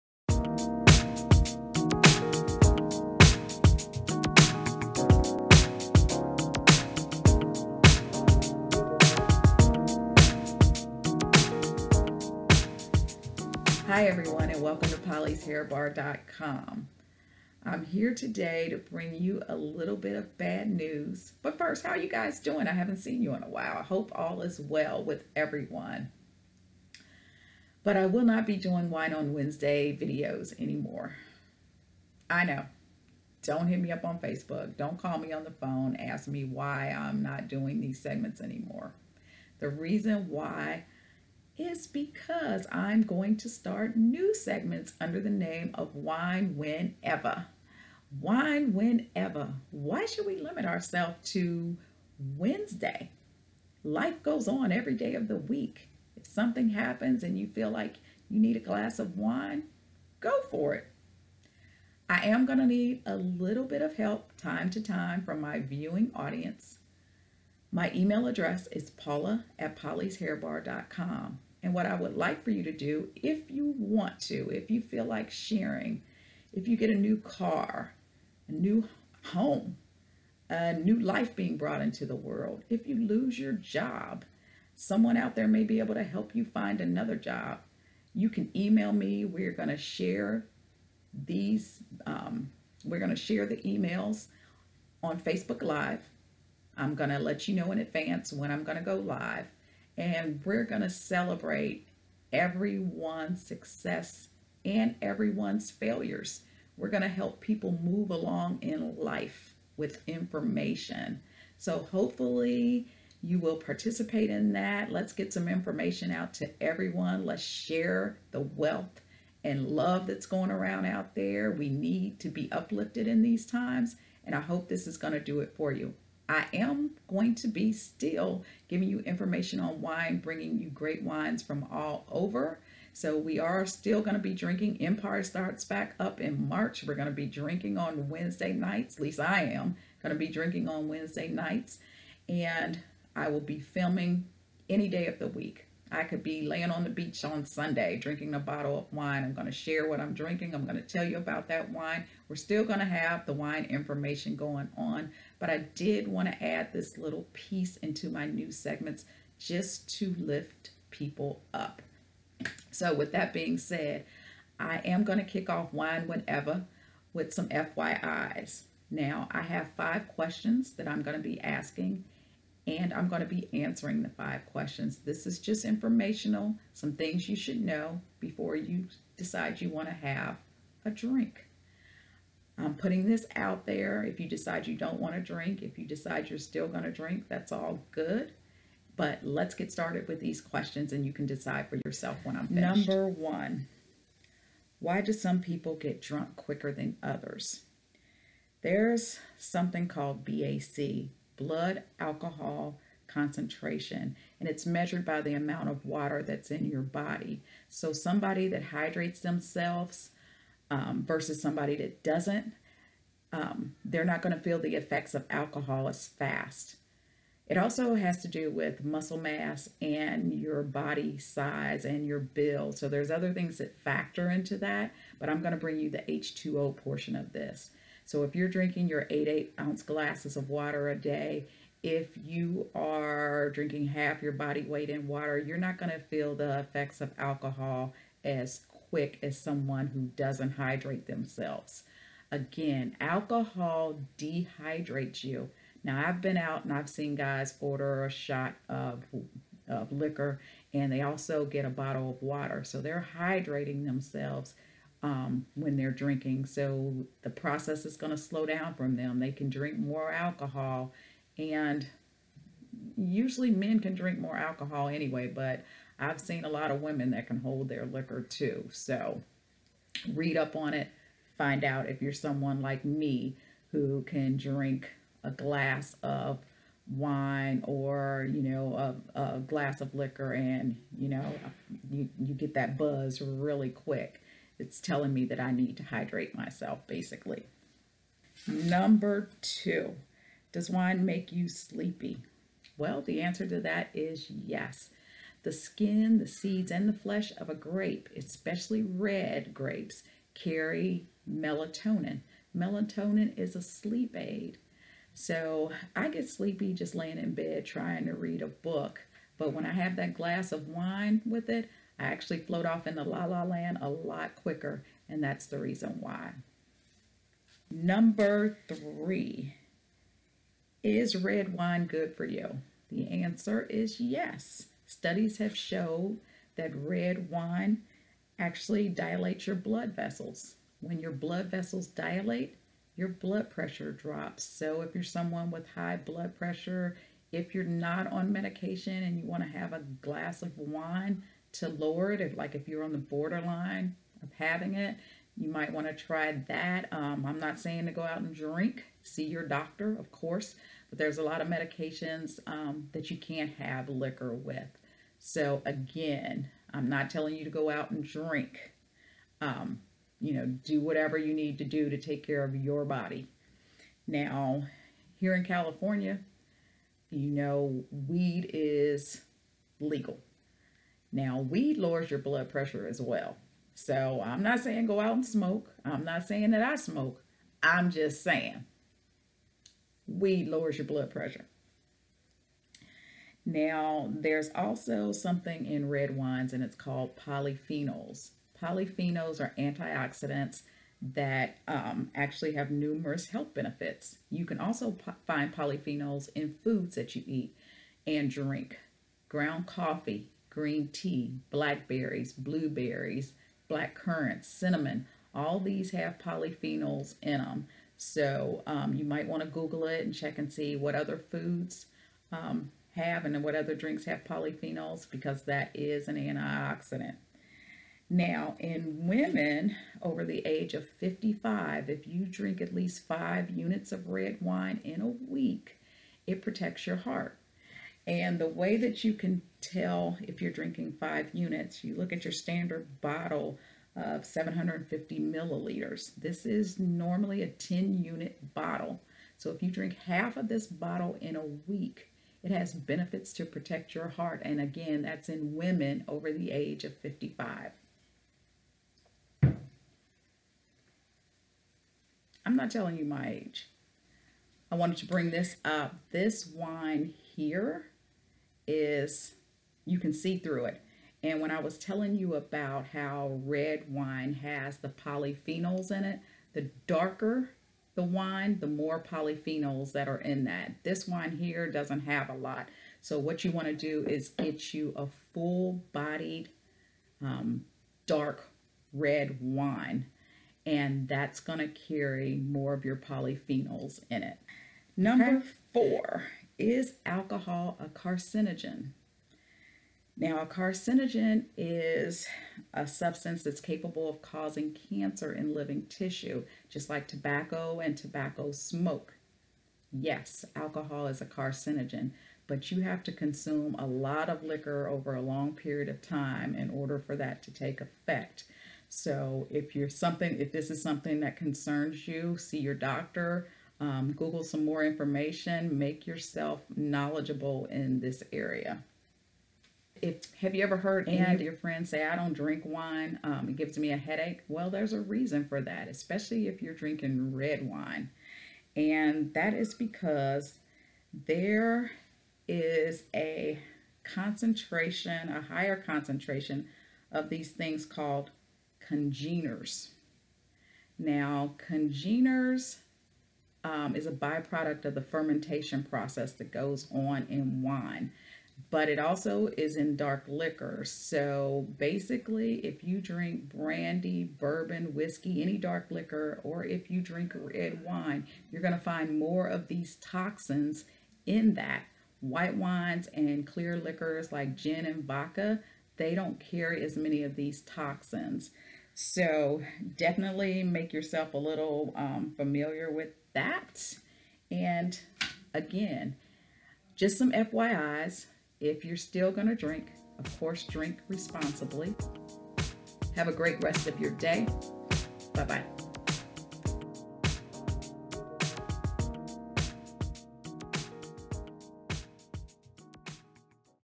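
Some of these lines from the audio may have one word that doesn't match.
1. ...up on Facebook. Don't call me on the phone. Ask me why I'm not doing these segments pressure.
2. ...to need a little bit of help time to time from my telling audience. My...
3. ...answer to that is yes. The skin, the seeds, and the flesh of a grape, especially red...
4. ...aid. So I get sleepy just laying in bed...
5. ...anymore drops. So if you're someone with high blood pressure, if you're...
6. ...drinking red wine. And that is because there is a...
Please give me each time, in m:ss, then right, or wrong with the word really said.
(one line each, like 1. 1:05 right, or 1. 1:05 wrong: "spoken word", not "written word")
1. 0:33 wrong: "anymore", not "pressure"
2. 1:02 wrong: "viewing", not "telling"
3. 4:53 right
4. 5:04 right
5. 5:33 wrong: "pressure", not "anymore"
6. 8:46 right.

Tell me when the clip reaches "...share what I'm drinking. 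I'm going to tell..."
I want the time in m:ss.
2:29.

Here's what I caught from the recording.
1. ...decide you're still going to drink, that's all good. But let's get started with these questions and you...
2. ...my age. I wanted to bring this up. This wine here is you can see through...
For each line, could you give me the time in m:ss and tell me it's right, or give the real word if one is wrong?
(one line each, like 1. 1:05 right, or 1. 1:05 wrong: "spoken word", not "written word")
1. 3:05 right
2. 7:33 right.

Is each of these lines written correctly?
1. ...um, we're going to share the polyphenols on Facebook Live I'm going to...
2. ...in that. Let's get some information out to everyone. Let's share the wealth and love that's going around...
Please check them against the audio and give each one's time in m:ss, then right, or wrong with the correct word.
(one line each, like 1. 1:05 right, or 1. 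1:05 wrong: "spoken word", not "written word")
1. 1:32 wrong: "emails", not "polyphenols"
2. 1:54 right.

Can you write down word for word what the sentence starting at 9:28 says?
So definitely make yourself a little um, familiar with that.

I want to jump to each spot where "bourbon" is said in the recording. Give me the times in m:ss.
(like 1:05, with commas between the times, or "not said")
9:14.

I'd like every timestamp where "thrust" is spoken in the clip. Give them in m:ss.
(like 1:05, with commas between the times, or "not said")
not said.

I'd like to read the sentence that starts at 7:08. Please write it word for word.
And the way that you can tell if you're drinking five units, you look at your standard bottle of 750 milliliters.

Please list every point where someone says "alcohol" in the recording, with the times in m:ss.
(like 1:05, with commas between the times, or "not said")
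3:21, 3:35, 3:57, 4:02, 4:20, 4:24, 8:07, 8:20.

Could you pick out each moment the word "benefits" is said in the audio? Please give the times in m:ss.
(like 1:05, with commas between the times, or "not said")
6:33, 7:22.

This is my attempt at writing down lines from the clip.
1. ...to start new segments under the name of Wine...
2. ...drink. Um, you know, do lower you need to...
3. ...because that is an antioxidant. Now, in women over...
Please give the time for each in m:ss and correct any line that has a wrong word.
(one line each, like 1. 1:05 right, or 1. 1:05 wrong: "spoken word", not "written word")
1. 0:43 right
2. 5:58 wrong: "whatever", not "lower"
3. 6:55 right.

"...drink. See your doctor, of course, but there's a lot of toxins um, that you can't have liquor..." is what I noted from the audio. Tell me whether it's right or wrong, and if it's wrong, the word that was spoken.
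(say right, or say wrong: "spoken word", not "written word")
wrong: "medications", not "toxins".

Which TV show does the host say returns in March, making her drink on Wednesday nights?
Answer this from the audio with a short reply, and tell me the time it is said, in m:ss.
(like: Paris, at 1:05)
Empire, at 2:14.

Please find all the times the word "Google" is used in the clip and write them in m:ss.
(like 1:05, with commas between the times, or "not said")
6:49, 8:34.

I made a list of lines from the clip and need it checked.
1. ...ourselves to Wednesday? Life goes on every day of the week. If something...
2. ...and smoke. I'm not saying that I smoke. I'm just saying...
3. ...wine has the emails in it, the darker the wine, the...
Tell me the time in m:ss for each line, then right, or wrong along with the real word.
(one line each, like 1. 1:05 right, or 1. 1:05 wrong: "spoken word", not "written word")
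1. 0:50 right
2. 6:15 right
3. 7:43 wrong: "polyphenols", not "emails".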